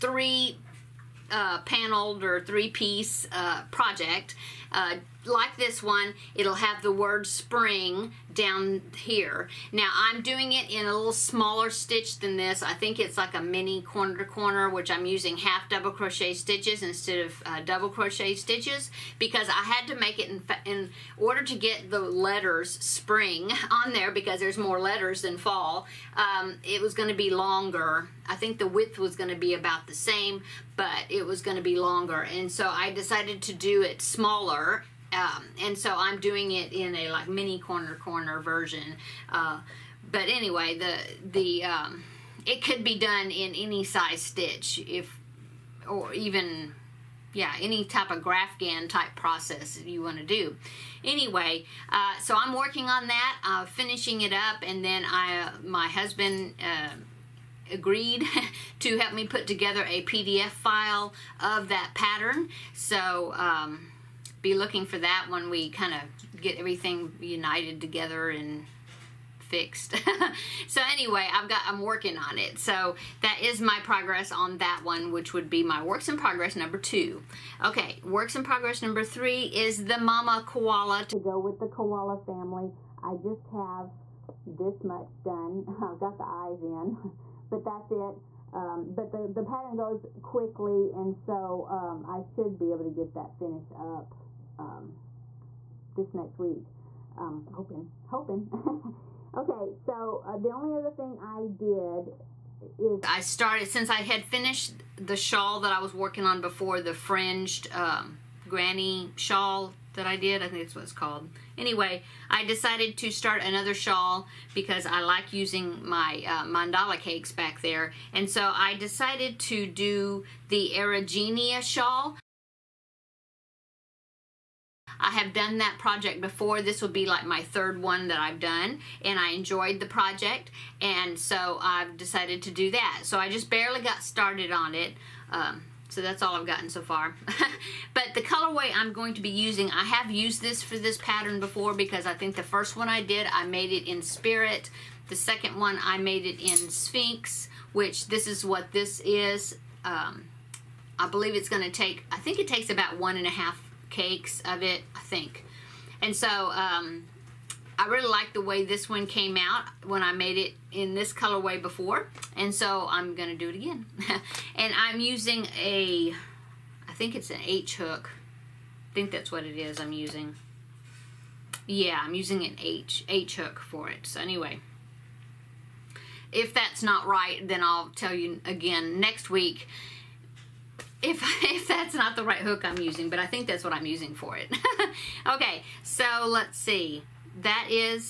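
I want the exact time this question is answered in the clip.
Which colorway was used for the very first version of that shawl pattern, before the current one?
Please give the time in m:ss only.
2:24.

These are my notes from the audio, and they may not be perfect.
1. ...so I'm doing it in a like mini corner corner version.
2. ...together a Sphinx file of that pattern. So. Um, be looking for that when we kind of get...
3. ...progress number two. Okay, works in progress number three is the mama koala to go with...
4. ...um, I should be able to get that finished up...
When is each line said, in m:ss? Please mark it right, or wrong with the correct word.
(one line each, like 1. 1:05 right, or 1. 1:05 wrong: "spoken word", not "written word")
1. 0:35 right
2. 0:59 wrong: "PDF", not "Sphinx"
3. 1:16 right
4. 1:31 right.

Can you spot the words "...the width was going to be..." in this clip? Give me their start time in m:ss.
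0:28.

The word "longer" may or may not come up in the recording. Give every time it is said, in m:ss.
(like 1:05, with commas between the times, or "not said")
0:27, 0:31.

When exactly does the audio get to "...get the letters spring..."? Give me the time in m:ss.
0:21.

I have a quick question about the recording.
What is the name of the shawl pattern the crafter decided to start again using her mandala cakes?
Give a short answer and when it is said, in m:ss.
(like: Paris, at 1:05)
Erigeneia shawl, at 2:00.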